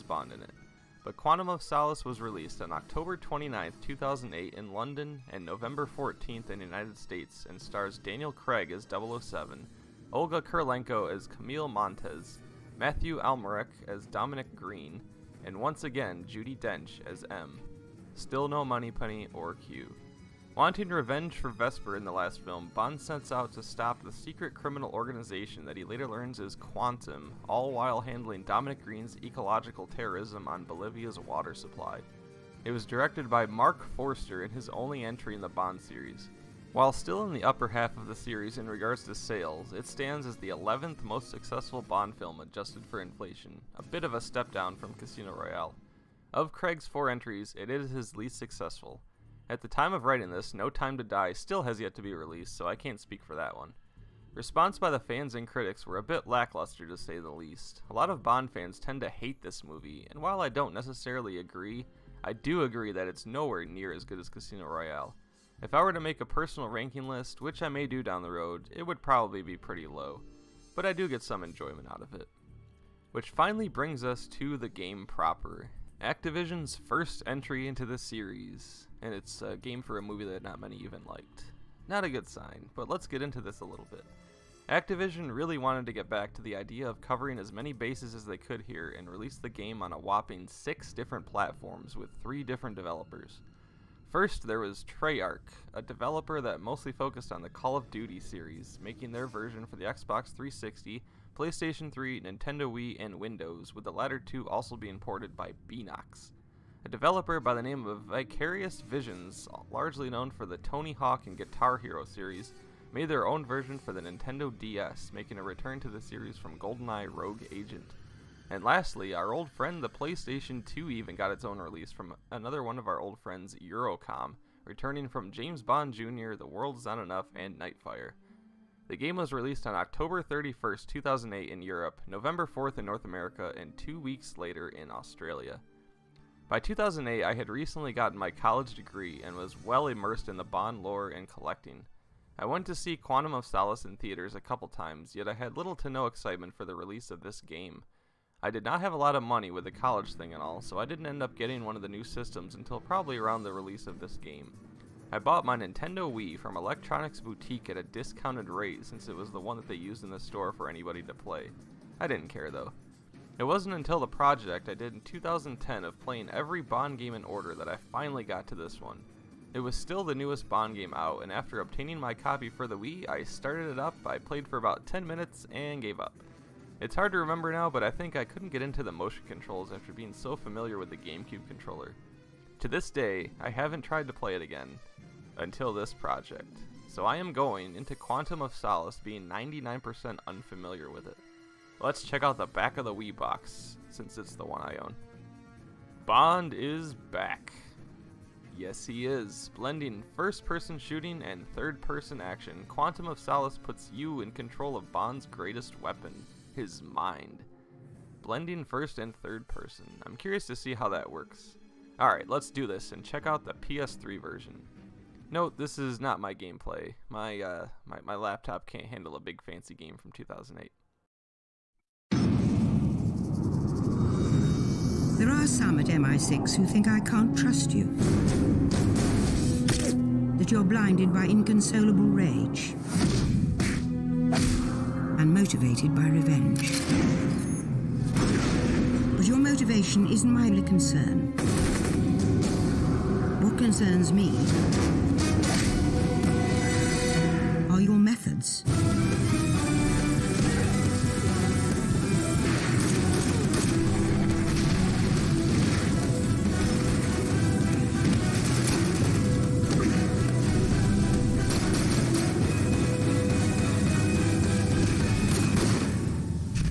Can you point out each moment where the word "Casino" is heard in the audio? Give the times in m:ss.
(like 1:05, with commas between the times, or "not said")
0:44, 1:04.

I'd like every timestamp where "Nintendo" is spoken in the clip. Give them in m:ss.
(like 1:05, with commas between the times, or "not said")
1:42, 1:54, 2:35.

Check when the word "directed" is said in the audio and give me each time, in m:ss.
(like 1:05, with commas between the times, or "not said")
0:32.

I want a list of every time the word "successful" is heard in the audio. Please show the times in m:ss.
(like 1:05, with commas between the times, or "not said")
0:41, 0:48.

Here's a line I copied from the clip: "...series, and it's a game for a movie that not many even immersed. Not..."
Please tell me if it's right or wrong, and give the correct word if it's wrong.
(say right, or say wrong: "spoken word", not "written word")
wrong: "liked", not "immersed".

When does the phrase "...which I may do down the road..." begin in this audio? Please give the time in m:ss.
1:07.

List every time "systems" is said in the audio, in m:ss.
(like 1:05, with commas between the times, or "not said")
2:32.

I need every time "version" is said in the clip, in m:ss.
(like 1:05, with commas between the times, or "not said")
1:39, 1:53, 3:34.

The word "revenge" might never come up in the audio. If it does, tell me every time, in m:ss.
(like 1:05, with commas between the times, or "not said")
0:20, 3:56.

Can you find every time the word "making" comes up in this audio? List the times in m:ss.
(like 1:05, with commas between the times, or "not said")
1:38, 1:55.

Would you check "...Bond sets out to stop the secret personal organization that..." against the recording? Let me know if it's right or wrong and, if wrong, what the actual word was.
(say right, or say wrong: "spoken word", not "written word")
wrong: "criminal", not "personal".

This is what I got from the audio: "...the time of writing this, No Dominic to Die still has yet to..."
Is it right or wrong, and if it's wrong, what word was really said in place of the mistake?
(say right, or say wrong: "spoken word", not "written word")
wrong: "Time", not "Dominic".